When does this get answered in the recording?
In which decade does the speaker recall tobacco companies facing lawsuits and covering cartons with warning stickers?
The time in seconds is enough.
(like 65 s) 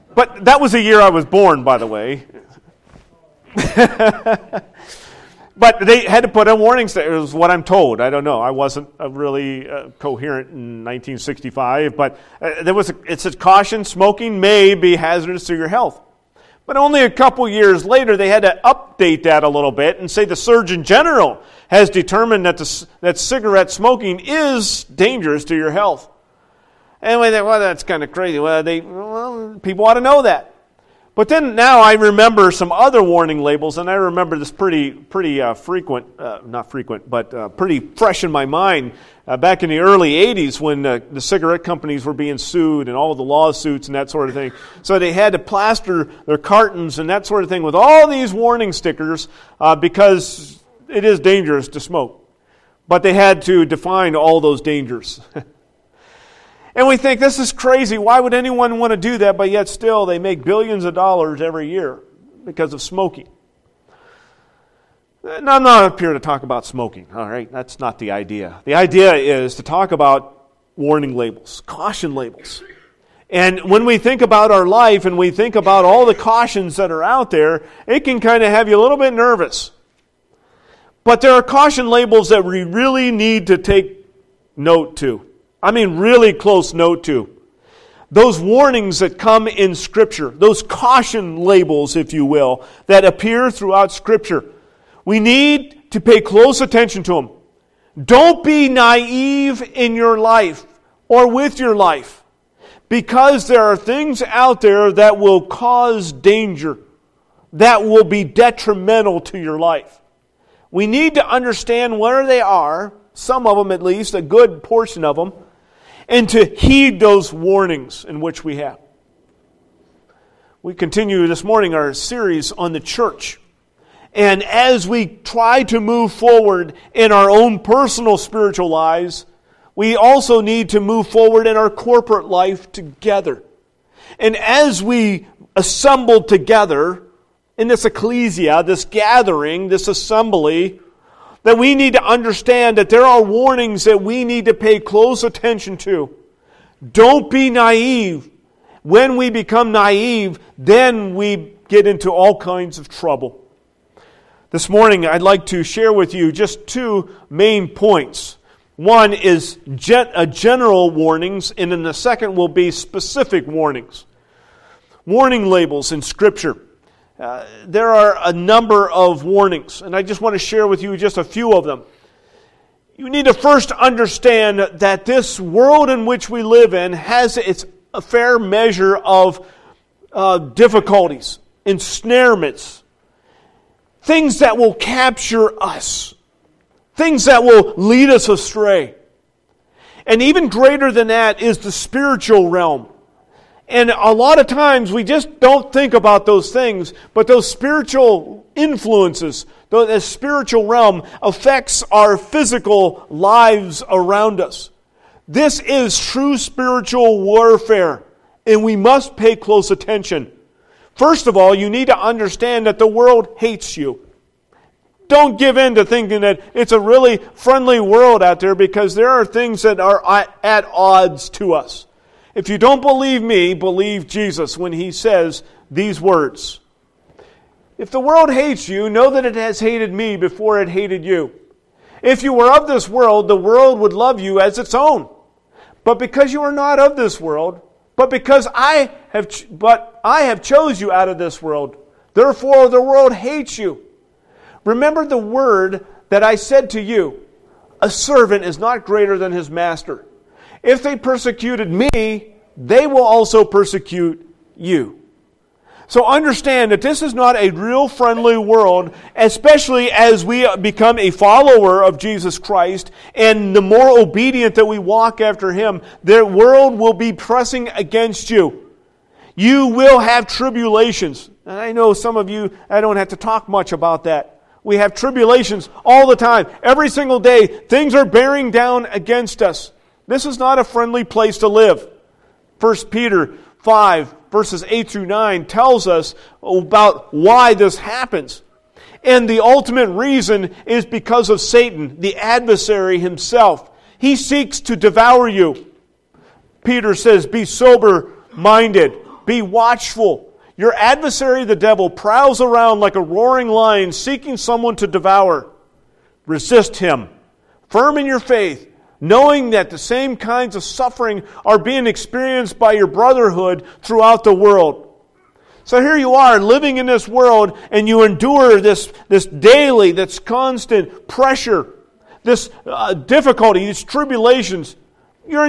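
39 s.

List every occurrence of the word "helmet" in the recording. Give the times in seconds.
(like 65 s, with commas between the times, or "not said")
not said.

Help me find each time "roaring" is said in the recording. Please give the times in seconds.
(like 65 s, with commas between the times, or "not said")
303 s.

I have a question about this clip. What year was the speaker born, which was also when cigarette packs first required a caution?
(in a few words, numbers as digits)
1965.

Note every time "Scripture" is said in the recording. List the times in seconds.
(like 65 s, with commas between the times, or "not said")
89 s, 93 s, 166 s.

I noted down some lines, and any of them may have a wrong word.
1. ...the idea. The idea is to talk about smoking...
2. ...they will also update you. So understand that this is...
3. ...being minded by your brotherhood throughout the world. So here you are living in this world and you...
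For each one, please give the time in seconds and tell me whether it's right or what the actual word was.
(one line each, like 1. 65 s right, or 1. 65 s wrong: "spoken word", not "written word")
1. 67 s wrong: "warning", not "smoking"
2. 252 s wrong: "persecute", not "update"
3. 311 s wrong: "experienced", not "minded".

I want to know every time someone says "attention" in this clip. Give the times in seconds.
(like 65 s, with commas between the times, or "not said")
96 s, 145 s, 209 s.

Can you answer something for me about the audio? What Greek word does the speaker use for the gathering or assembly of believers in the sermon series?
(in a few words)
ecclesia.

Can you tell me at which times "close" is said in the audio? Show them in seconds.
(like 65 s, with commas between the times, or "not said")
86 s, 96 s, 144 s, 209 s.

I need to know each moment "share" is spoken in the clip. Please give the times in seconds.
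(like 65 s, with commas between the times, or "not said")
155 s, 170 s.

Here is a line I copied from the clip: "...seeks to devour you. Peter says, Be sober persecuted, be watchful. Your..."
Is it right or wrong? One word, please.
wrong.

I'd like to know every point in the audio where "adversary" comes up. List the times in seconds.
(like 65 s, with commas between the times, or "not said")
292 s, 300 s.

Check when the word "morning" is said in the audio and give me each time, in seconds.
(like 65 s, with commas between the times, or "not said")
121 s, 154 s.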